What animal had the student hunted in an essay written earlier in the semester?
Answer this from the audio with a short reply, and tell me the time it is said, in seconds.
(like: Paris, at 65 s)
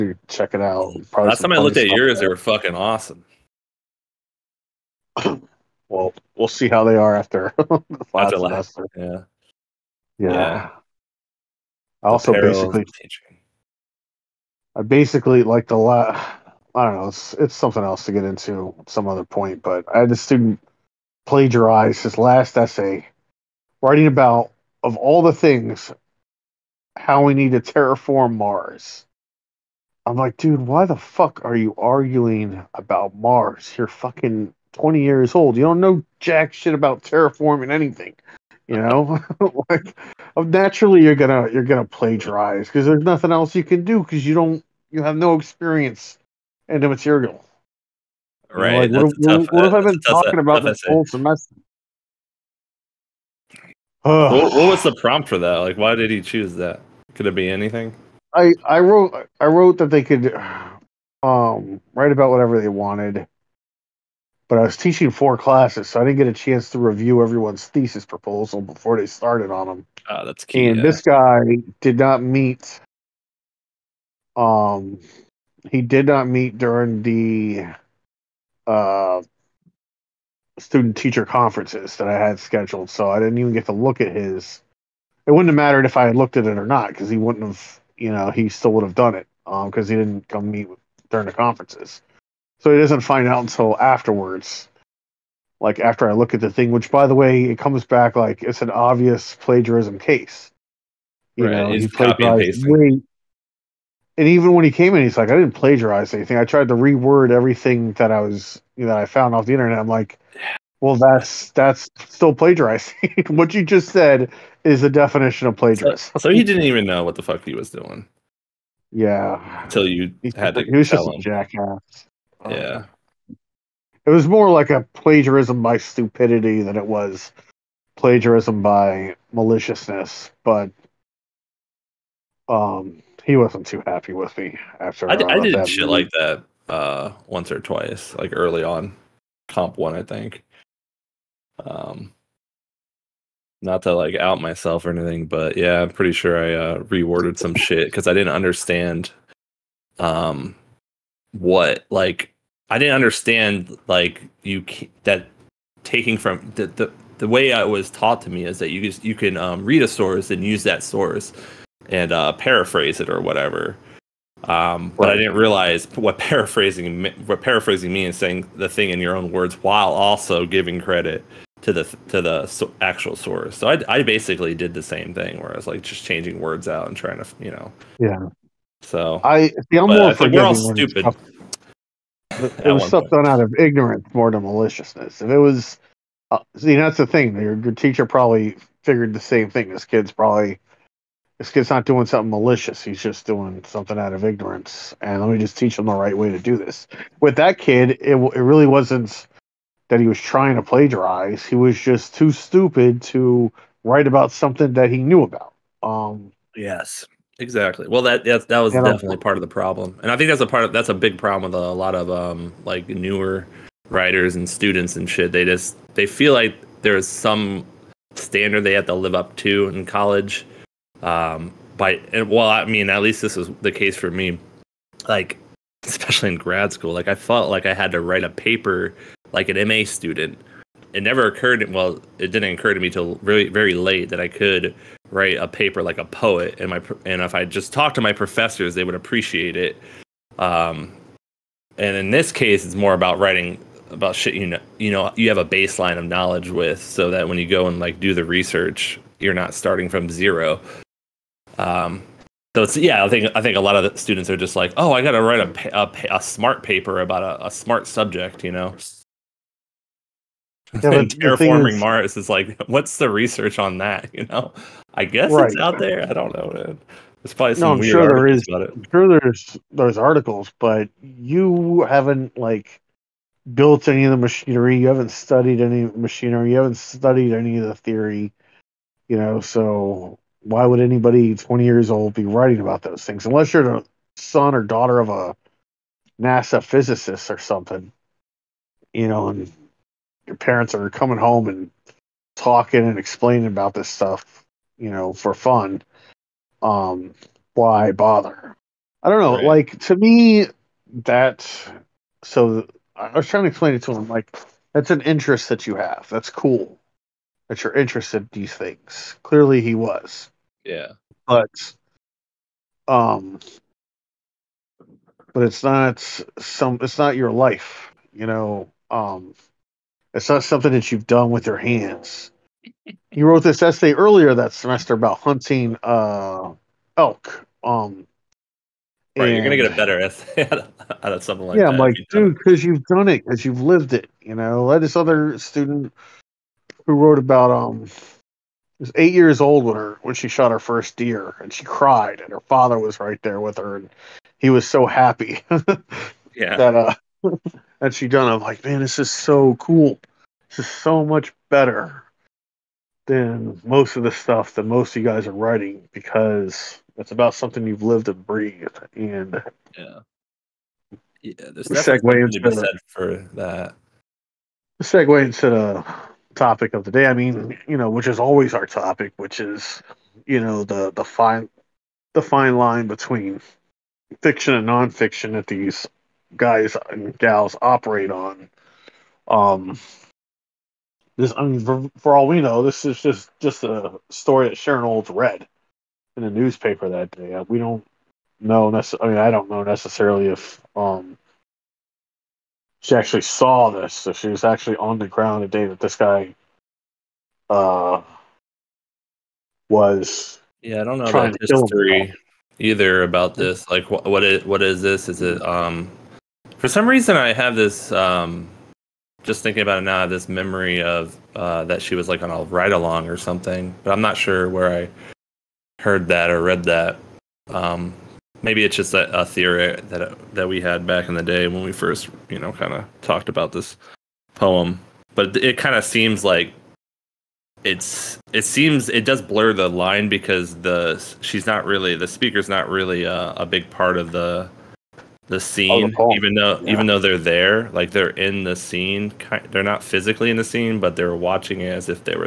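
Elk, at 326 s.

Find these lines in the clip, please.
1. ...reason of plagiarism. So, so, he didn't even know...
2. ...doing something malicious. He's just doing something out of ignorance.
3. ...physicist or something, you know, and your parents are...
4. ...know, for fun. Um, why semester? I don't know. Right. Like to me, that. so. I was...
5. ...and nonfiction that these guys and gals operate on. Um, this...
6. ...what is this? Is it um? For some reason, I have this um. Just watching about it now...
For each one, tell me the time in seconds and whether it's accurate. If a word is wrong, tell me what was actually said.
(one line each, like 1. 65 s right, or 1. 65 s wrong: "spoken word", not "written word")
1. 114 s wrong: "definition", not "reason"
2. 191 s right
3. 286 s right
4. 294 s wrong: "bother", not "semester"
5. 374 s right
6. 404 s wrong: "thinking", not "watching".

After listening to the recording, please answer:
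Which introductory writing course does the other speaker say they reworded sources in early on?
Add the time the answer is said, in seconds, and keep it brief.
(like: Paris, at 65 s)
Comp one, at 139 s.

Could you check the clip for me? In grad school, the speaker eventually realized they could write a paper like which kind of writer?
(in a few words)
A poet.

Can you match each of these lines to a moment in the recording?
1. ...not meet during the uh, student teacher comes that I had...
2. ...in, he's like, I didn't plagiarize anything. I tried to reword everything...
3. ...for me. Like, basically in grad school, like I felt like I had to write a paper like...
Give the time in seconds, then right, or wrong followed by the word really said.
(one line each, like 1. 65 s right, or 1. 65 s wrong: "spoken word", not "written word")
1. 76 s wrong: "conferences", not "comes"
2. 104 s right
3. 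223 s wrong: "especially", not "basically".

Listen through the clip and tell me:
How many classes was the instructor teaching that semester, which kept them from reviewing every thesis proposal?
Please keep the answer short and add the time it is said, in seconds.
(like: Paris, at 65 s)
4, at 65 s.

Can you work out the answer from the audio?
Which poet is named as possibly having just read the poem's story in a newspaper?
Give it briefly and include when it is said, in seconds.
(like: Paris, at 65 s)
Sharon Olds, at 384 s.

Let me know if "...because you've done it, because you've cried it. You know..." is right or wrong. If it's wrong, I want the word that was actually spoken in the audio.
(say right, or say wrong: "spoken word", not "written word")
wrong: "lived", not "cried".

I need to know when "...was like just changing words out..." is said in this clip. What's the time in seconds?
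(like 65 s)
175 s.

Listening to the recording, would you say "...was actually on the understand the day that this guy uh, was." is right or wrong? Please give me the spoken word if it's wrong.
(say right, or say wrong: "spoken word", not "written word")
wrong: "ground", not "understand".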